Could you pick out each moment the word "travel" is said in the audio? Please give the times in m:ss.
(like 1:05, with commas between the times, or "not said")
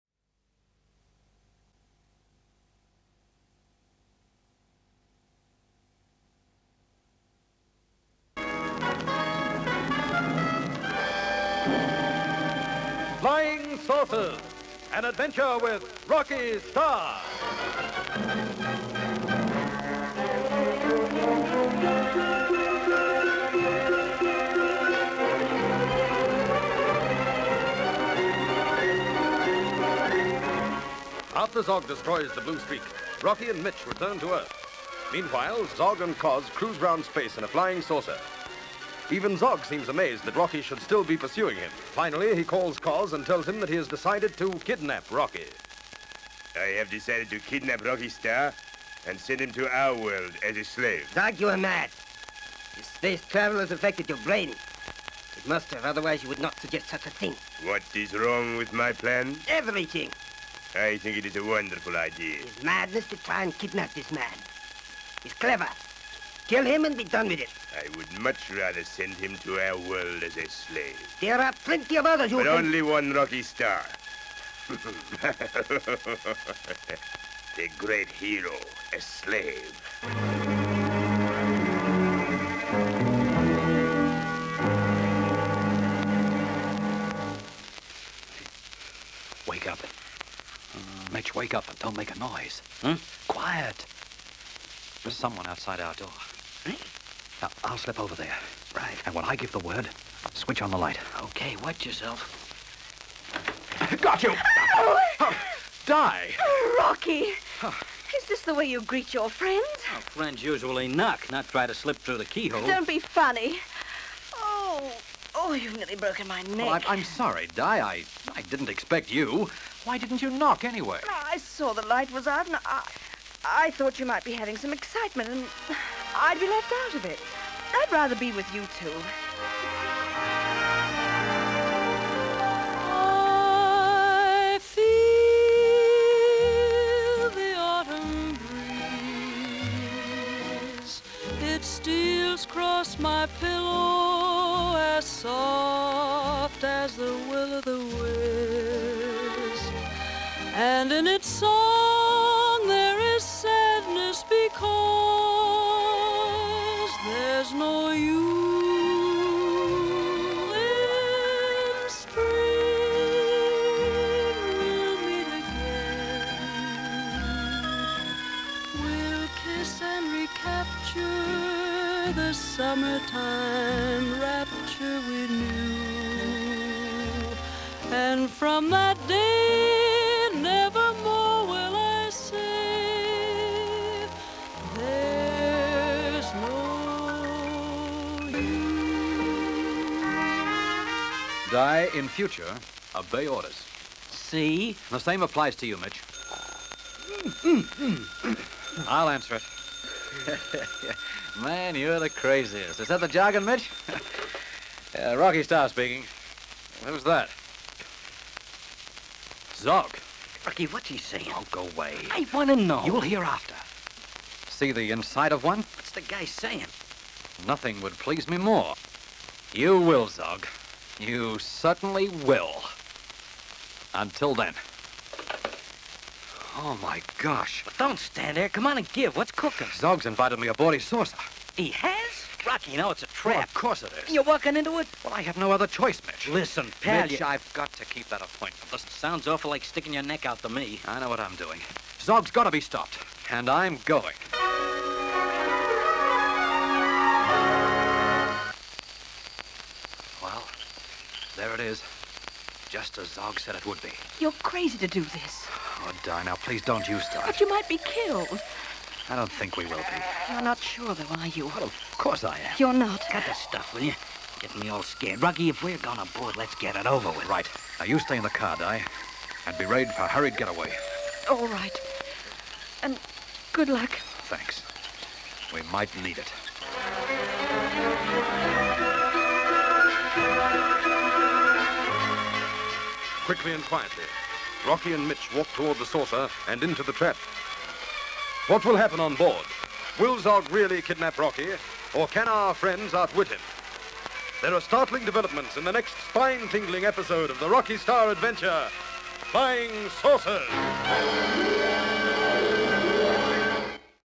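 0:53.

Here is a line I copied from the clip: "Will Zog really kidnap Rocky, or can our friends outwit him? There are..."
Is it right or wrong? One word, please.
right.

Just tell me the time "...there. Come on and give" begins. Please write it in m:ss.
3:48.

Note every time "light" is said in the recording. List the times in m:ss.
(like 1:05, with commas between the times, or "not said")
1:40, 2:01.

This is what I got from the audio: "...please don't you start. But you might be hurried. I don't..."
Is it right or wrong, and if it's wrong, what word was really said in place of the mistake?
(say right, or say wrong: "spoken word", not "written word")
wrong: "killed", not "hurried".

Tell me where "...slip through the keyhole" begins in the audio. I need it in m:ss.
1:51.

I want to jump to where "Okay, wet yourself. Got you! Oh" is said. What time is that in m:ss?
1:41.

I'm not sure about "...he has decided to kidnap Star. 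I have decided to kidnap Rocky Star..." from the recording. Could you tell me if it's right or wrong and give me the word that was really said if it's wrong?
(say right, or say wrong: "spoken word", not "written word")
wrong: "Rocky", not "Star".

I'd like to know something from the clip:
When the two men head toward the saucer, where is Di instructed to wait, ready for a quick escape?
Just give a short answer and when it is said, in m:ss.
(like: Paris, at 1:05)
the car, at 4:28.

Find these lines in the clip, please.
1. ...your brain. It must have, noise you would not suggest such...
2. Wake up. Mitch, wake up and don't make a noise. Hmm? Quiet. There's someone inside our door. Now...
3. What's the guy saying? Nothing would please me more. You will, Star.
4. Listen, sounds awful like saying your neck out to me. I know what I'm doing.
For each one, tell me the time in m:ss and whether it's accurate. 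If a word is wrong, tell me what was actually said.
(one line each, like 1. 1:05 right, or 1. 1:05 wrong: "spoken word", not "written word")
1. 0:54 wrong: "otherwise", not "noise"
2. 1:29 wrong: "outside", not "inside"
3. 3:35 wrong: "Zog", not "Star"
4. 3:58 wrong: "sticking", not "saying".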